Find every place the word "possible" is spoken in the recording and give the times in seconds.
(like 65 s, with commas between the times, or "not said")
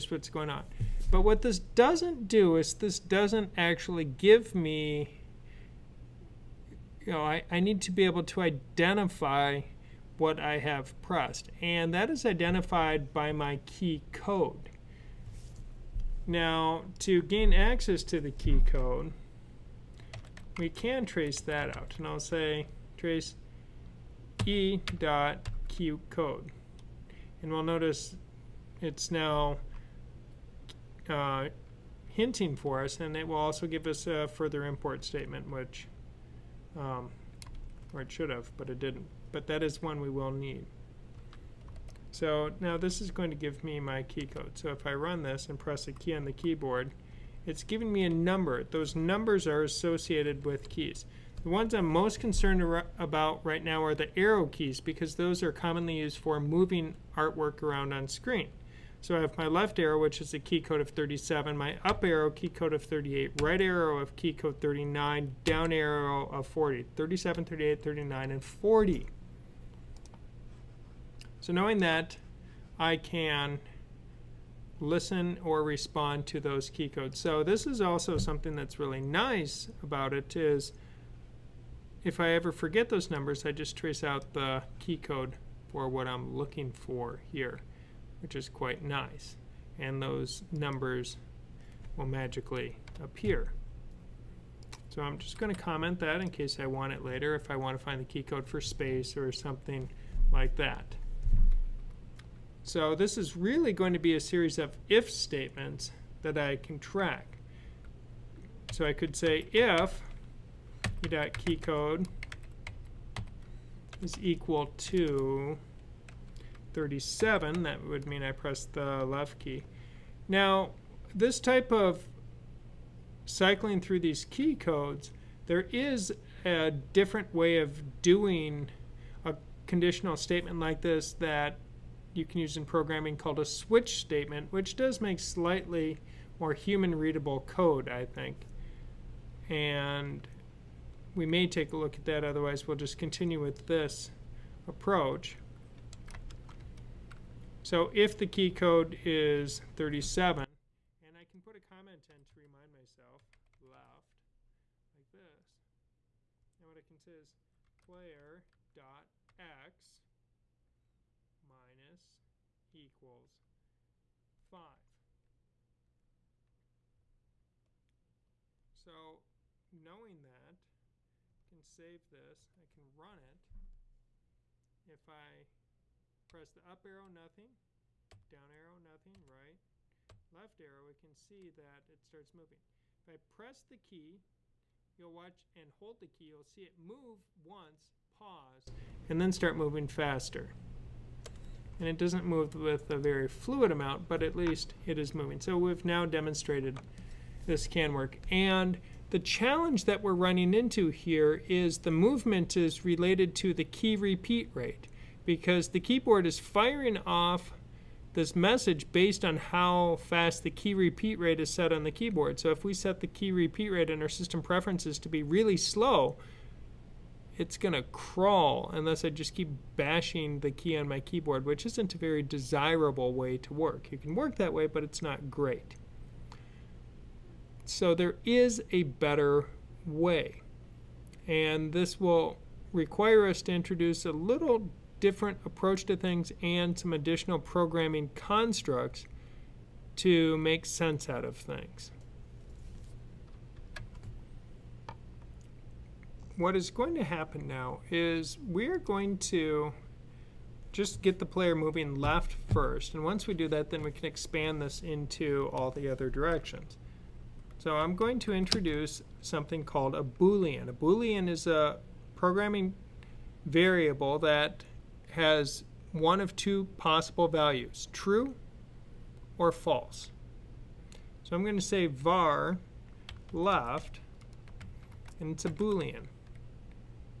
266 s.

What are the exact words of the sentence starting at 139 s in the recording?
And we may take a look at that, otherwise we'll just continue with this approach.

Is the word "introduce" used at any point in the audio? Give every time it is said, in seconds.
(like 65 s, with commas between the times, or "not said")
233 s, 258 s.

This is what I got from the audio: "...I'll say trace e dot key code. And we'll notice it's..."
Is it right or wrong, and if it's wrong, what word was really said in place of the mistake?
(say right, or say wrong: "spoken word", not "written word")
right.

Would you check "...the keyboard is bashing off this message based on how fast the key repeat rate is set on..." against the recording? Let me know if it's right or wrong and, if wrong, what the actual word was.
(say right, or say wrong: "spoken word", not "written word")
wrong: "firing", not "bashing".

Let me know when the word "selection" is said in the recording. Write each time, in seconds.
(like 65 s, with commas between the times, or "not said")
not said.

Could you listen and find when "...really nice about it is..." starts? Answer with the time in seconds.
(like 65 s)
78 s.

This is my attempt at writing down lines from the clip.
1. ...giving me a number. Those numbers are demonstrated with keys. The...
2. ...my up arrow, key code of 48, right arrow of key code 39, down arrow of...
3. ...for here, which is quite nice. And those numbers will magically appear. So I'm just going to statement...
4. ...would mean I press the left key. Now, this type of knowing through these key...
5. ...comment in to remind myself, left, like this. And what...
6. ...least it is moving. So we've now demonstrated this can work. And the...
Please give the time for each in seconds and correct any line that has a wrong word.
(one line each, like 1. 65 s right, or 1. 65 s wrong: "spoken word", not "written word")
1. 47 s wrong: "associated", not "demonstrated"
2. 61 s wrong: "38", not "48"
3. 86 s wrong: "comment", not "statement"
4. 117 s wrong: "cycling", not "knowing"
5. 151 s right
6. 194 s right.